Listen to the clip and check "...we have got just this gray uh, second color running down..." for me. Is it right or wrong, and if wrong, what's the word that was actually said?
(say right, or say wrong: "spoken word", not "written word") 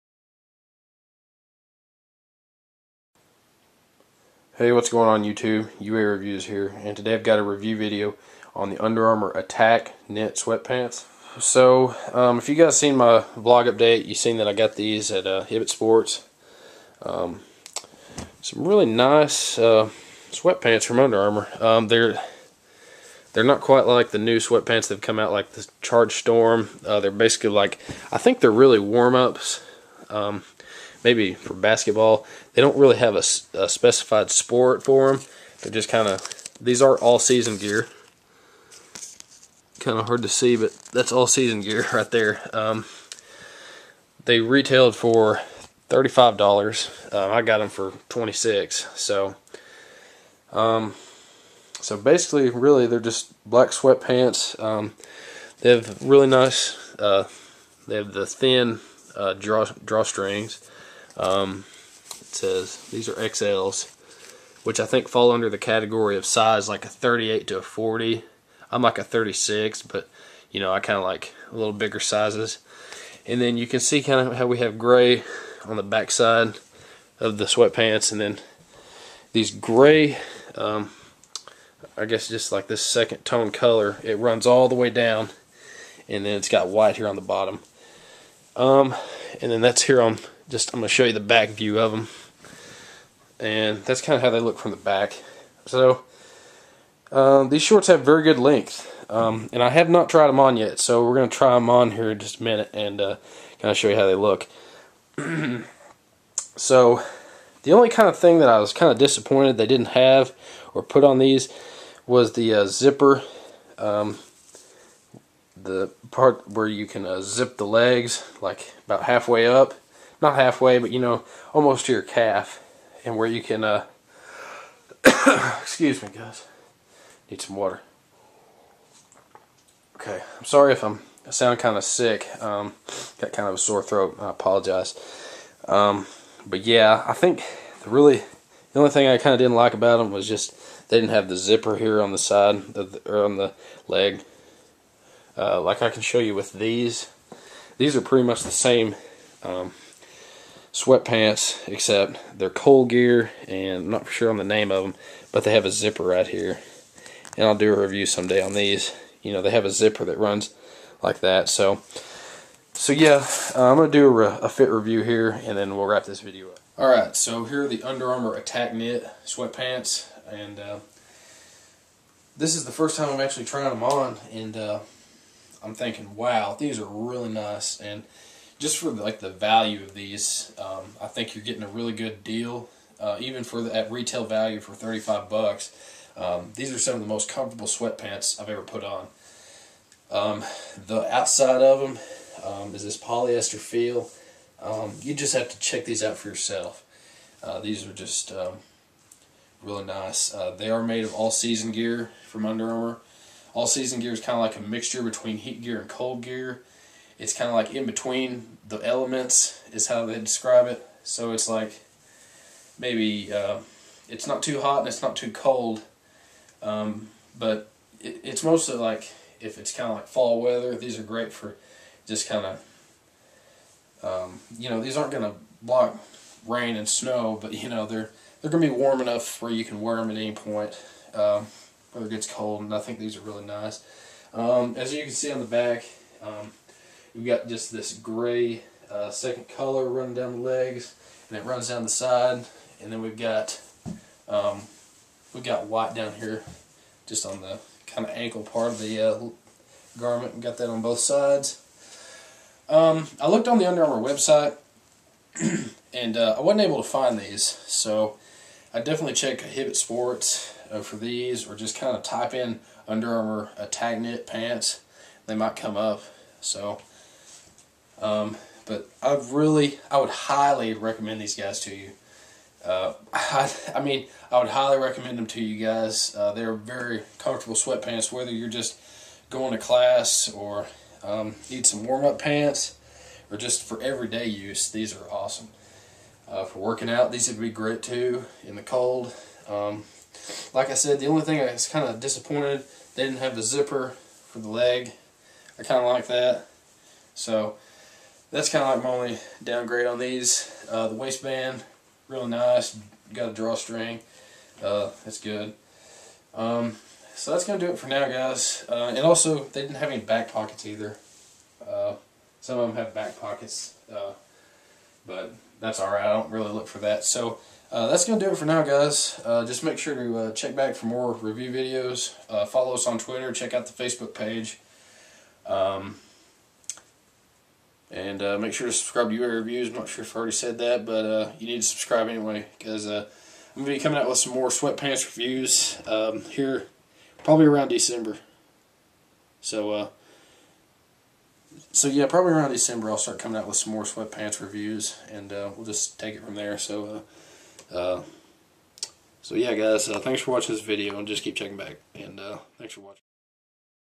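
right.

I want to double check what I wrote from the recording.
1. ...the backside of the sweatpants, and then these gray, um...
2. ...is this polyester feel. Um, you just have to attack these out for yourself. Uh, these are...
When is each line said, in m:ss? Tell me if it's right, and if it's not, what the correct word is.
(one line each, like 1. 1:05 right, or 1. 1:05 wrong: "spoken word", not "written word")
1. 1:15 right
2. 3:12 wrong: "check", not "attack".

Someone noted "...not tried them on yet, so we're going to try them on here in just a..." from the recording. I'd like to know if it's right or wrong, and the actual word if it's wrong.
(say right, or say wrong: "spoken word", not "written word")
right.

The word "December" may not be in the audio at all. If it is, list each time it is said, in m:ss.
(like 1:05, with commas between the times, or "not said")
5:37, 5:42.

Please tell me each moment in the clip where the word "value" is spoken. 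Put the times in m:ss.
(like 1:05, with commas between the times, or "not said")
2:59, 3:04.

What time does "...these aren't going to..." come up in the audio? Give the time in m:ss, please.
3:44.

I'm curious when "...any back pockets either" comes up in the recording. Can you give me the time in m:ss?
5:09.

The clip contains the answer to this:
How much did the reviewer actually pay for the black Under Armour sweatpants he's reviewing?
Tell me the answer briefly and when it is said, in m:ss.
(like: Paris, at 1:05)
26, at 0:48.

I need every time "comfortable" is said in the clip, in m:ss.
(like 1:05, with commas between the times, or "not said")
3:07, 4:37.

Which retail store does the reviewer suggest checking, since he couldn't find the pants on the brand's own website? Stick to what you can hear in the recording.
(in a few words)
Hibbett Sports.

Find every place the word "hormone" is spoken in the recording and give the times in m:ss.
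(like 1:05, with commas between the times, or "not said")
not said.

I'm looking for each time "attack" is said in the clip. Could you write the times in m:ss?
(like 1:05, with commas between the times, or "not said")
0:09, 2:48, 4:23.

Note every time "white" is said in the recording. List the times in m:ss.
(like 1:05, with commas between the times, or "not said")
1:26, 4:05.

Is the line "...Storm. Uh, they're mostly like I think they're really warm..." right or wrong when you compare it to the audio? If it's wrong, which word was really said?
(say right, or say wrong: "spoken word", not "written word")
wrong: "basically", not "mostly".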